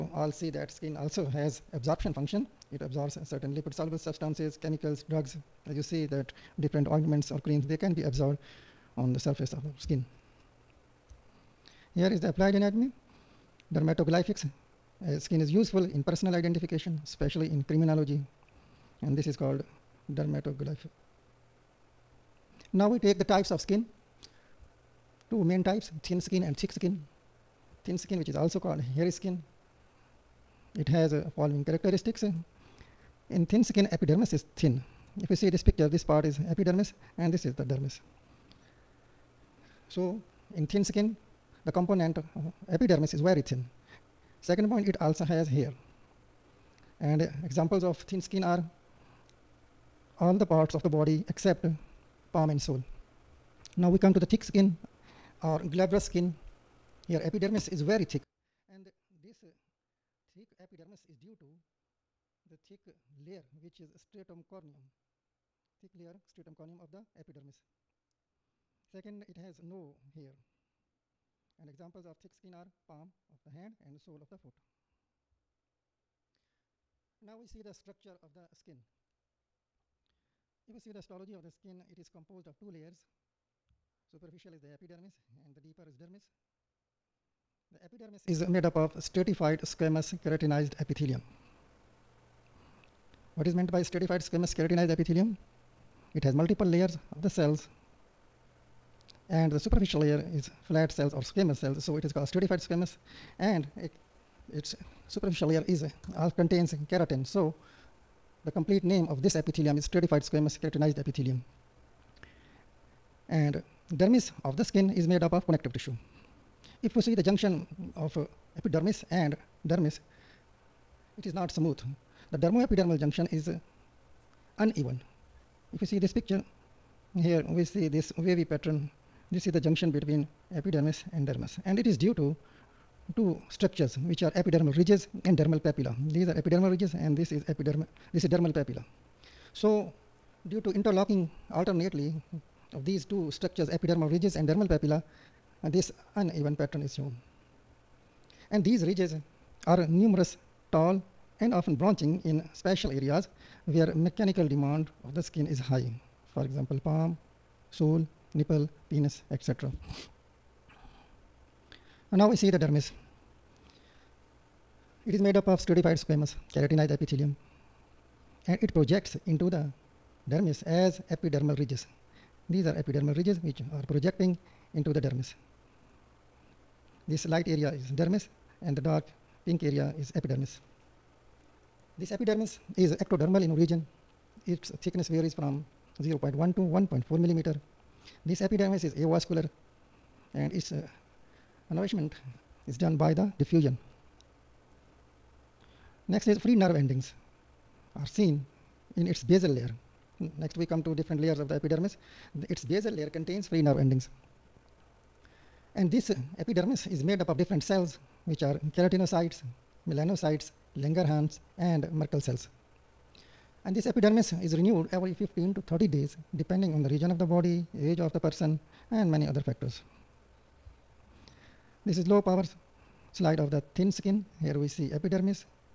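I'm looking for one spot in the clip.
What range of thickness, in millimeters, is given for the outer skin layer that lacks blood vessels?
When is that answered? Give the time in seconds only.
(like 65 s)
186 s.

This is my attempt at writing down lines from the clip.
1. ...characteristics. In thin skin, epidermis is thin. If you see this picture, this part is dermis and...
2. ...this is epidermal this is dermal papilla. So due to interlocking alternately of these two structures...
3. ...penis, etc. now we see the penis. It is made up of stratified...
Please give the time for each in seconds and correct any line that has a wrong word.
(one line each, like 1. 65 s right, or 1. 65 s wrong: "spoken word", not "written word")
1. 31 s wrong: "epidermis", not "dermis"
2. 137 s right
3. 158 s wrong: "dermis", not "penis".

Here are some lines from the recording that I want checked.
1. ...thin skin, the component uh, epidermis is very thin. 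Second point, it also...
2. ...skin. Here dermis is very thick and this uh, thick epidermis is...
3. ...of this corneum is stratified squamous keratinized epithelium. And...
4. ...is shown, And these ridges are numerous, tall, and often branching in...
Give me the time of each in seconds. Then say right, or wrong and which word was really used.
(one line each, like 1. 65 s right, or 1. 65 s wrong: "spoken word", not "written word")
1. 40 s right
2. 56 s wrong: "epidermis", not "dermis"
3. 109 s wrong: "epithelium", not "corneum"
4. 146 s right.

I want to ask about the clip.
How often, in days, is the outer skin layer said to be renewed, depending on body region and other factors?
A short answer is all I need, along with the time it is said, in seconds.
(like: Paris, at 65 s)
15 to 30 days, at 215 s.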